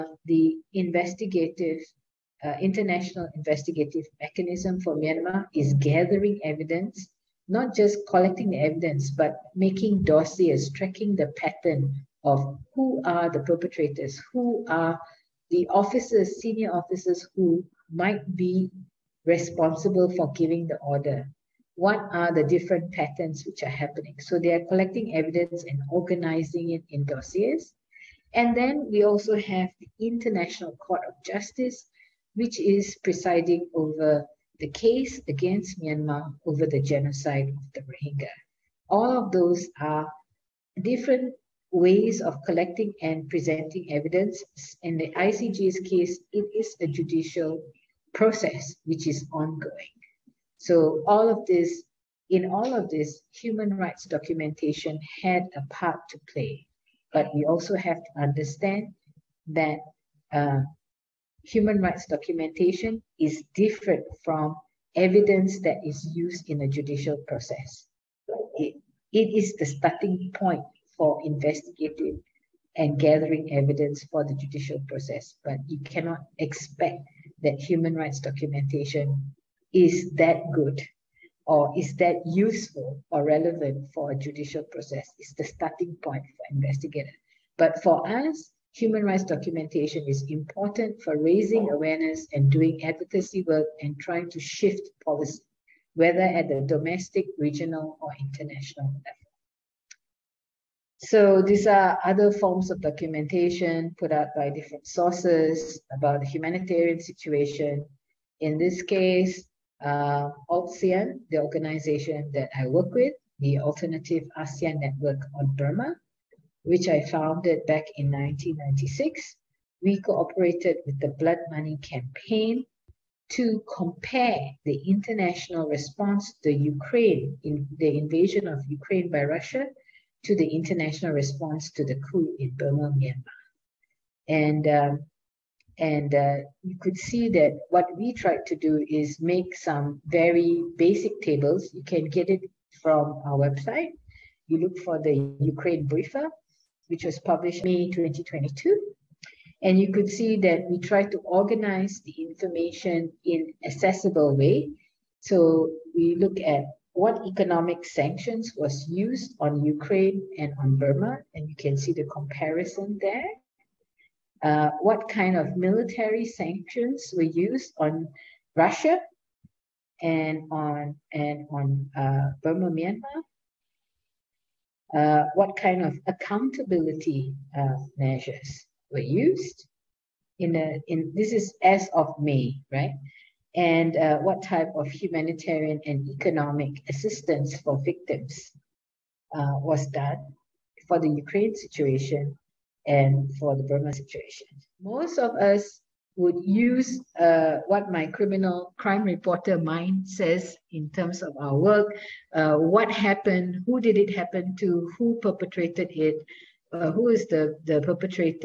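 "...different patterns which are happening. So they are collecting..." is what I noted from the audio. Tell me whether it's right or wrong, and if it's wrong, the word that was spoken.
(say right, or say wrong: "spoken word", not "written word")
right.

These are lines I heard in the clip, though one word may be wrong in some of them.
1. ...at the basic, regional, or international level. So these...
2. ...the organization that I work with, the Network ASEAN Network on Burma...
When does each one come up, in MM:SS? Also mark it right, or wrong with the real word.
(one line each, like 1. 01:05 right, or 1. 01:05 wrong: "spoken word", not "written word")
1. 01:36 wrong: "domestic", not "basic"
2. 01:51 wrong: "Alternative", not "Network".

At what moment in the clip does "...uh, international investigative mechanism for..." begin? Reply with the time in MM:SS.
00:02.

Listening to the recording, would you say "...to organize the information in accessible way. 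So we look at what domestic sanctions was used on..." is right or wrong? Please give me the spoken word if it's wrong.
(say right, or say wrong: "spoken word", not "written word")
wrong: "economic", not "domestic".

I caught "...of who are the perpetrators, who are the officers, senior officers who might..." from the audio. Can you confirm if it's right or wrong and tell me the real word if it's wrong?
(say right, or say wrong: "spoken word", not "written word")
right.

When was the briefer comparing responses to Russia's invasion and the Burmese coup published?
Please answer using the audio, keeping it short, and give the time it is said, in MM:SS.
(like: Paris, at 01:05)
May 2022, at 02:27.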